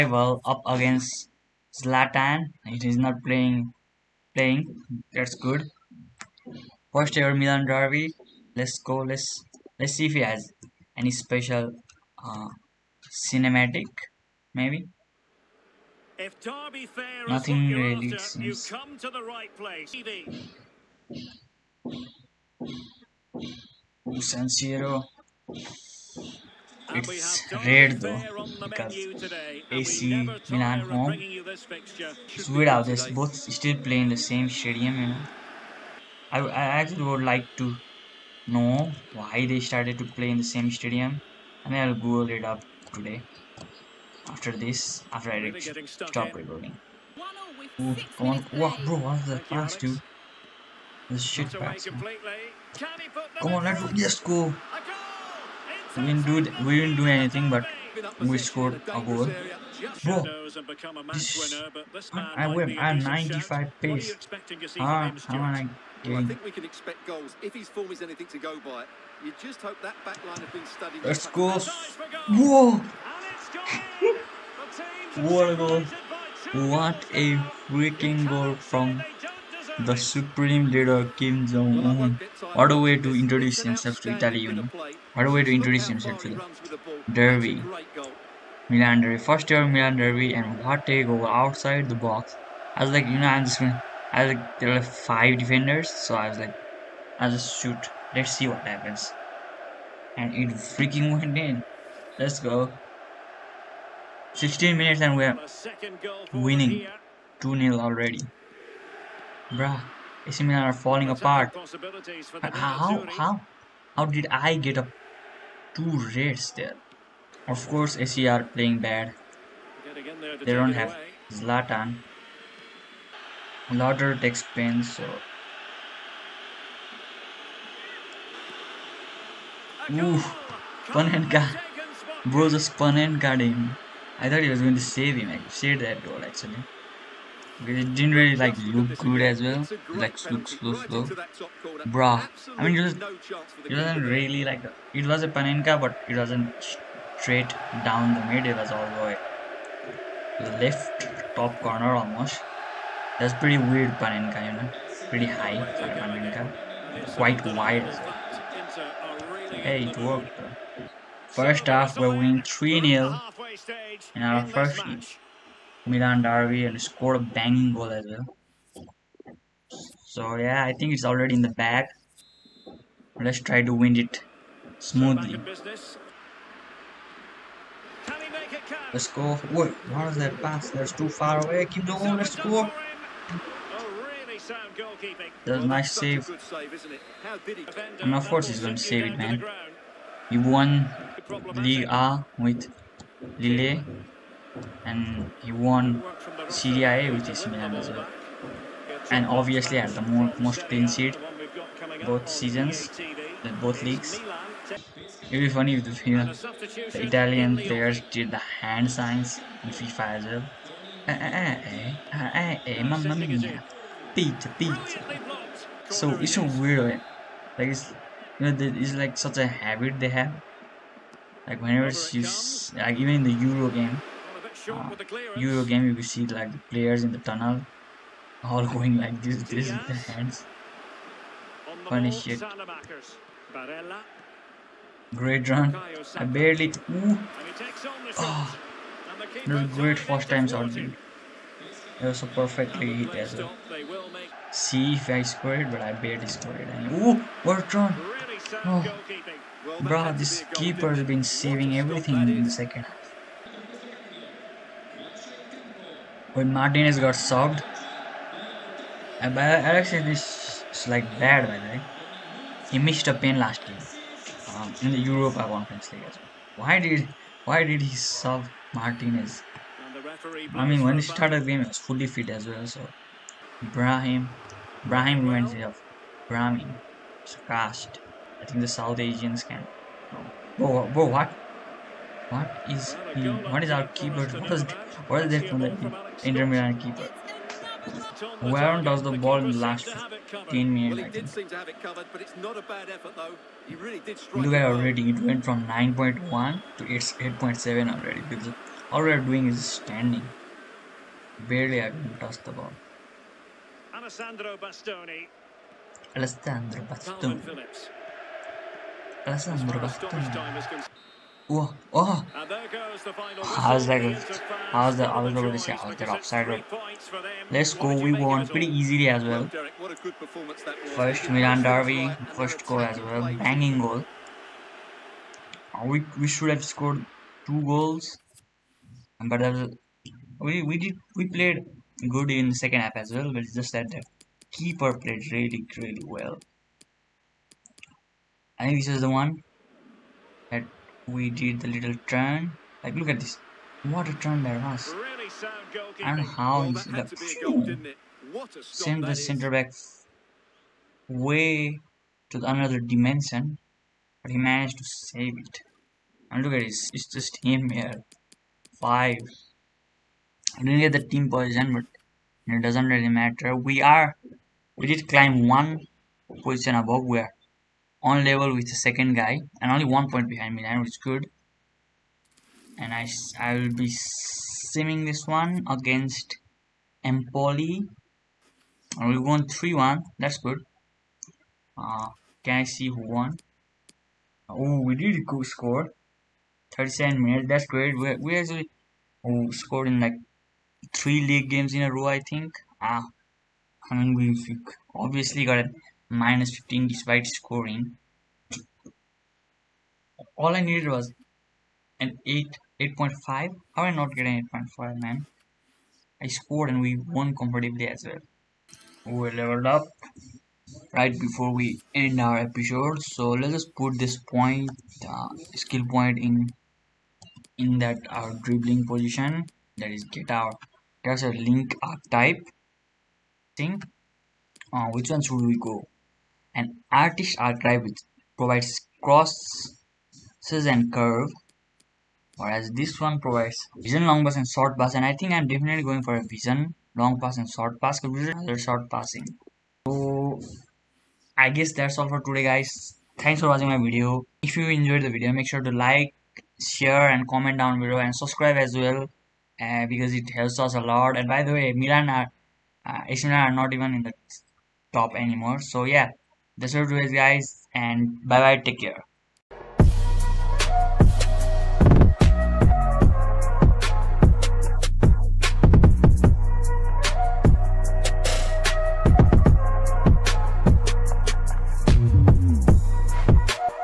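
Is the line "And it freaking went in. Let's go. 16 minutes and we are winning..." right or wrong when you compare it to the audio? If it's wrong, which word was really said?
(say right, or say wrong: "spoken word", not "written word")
right.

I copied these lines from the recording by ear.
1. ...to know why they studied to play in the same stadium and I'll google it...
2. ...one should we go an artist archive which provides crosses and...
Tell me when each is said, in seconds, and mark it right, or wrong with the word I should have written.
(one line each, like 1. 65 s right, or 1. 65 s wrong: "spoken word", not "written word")
1. 37 s wrong: "started", not "studied"
2. 425 s right.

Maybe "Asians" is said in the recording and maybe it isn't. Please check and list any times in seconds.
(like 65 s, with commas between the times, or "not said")
278 s.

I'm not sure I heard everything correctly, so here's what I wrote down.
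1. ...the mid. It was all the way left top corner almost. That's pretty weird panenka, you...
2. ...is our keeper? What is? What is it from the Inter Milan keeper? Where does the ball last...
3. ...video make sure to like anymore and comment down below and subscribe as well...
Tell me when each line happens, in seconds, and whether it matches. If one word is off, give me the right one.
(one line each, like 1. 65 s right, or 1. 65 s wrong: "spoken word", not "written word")
1. 148 s right
2. 283 s right
3. 445 s wrong: "share", not "anymore".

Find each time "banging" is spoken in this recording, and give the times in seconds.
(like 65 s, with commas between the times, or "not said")
167 s, 323 s.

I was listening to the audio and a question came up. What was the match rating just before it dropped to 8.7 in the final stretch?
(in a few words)
9.1.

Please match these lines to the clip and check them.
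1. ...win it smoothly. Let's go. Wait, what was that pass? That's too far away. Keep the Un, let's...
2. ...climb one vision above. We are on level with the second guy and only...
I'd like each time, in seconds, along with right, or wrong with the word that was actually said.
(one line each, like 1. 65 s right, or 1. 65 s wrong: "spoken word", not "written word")
1. 173 s right
2. 365 s wrong: "position", not "vision".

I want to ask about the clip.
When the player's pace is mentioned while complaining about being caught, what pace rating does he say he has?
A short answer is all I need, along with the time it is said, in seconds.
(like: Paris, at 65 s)
95, at 62 s.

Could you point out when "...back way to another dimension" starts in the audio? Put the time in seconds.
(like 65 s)
349 s.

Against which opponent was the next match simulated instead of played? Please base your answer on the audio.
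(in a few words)
Empoli.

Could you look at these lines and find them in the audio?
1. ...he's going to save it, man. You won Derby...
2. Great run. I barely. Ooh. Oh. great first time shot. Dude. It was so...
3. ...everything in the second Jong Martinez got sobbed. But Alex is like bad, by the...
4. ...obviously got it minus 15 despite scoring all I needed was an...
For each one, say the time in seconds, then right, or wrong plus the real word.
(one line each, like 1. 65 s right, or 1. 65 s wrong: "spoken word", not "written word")
1. 188 s wrong: "League", not "Derby"
2. 235 s right
3. 251 s wrong: "When", not "Jong"
4. 394 s right.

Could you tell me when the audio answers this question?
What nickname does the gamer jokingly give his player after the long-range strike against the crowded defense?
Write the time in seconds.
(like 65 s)
81 s.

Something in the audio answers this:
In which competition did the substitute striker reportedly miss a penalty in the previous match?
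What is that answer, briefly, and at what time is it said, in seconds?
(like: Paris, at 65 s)
Europa Conference League, at 264 s.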